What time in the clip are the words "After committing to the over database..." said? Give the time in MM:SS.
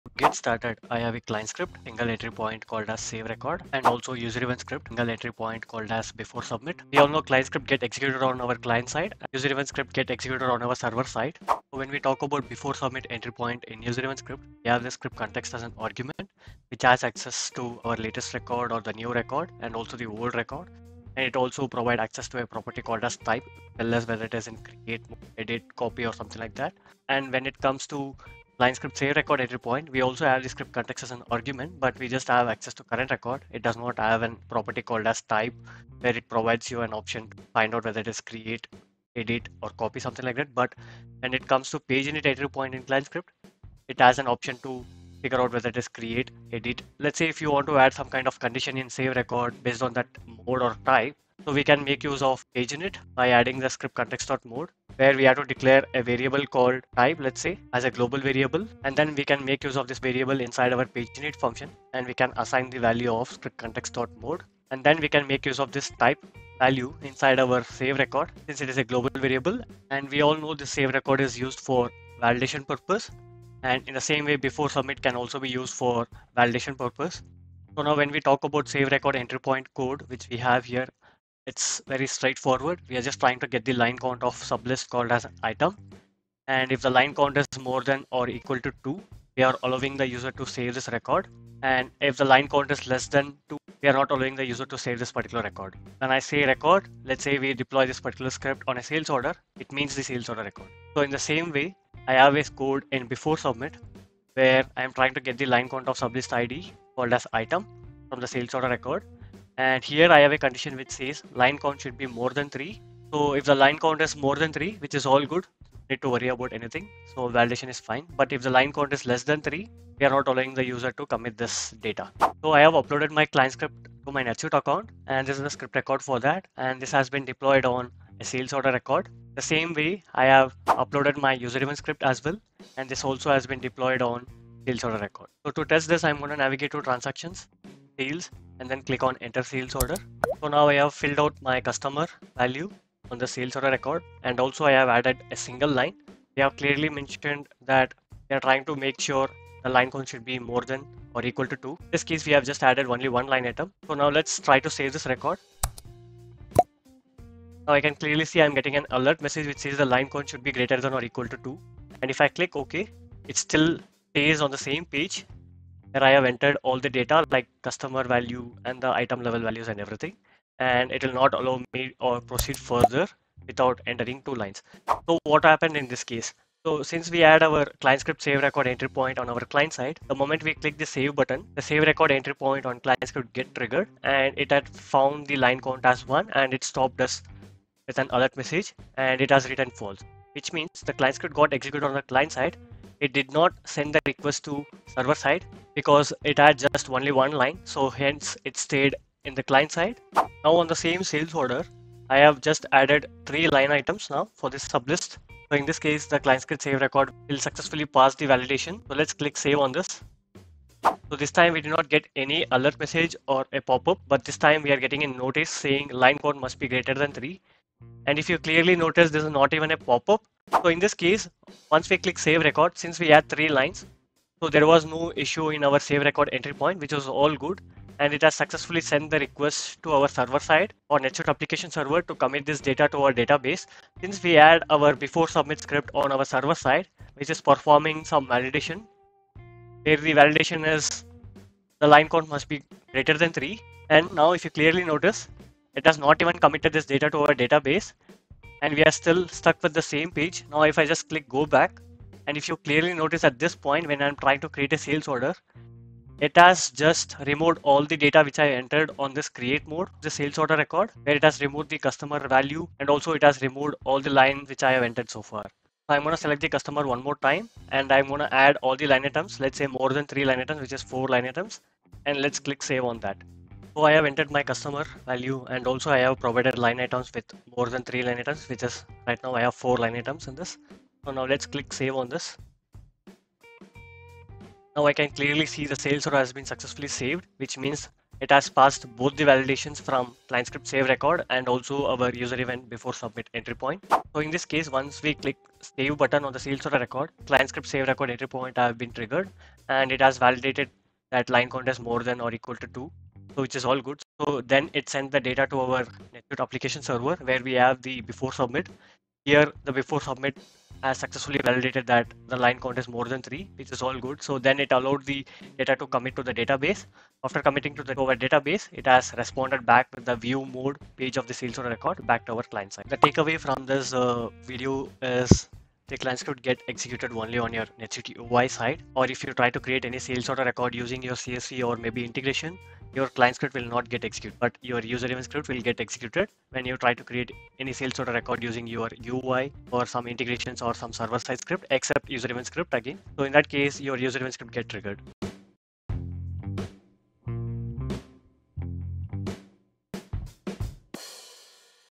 05:17.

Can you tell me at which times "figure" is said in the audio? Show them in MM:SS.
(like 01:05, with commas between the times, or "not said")
00:45.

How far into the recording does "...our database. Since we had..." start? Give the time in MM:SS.
03:53.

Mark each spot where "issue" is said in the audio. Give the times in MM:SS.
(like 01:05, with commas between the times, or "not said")
03:45.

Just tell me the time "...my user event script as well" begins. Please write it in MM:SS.
02:11.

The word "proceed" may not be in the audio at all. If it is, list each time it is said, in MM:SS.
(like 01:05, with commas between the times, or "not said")
02:52.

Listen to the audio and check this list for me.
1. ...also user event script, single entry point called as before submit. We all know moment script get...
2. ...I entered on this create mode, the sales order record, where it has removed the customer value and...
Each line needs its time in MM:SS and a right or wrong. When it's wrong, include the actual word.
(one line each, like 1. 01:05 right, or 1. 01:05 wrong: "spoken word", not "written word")
1. 00:03 wrong: "client", not "moment"
2. 04:18 right.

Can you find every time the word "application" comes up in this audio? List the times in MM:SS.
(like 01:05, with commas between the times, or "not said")
03:51, 05:06.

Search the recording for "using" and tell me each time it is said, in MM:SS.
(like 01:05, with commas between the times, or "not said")
05:30, 05:38.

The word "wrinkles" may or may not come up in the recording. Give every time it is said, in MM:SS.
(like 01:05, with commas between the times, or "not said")
not said.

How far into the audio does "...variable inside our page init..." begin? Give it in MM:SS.
00:59.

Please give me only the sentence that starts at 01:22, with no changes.
We are just trying to get the line count of sublist called as item.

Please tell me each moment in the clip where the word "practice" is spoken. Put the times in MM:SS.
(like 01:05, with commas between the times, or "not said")
not said.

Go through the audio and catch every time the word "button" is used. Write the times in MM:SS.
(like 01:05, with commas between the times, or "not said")
03:01, 04:55.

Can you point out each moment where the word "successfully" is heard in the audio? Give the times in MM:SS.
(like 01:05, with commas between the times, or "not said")
03:27, 03:48, 04:46, 05:10.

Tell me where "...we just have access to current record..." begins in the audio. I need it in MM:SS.
00:31.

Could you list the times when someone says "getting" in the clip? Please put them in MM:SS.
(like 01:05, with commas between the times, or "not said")
02:38, 03:34.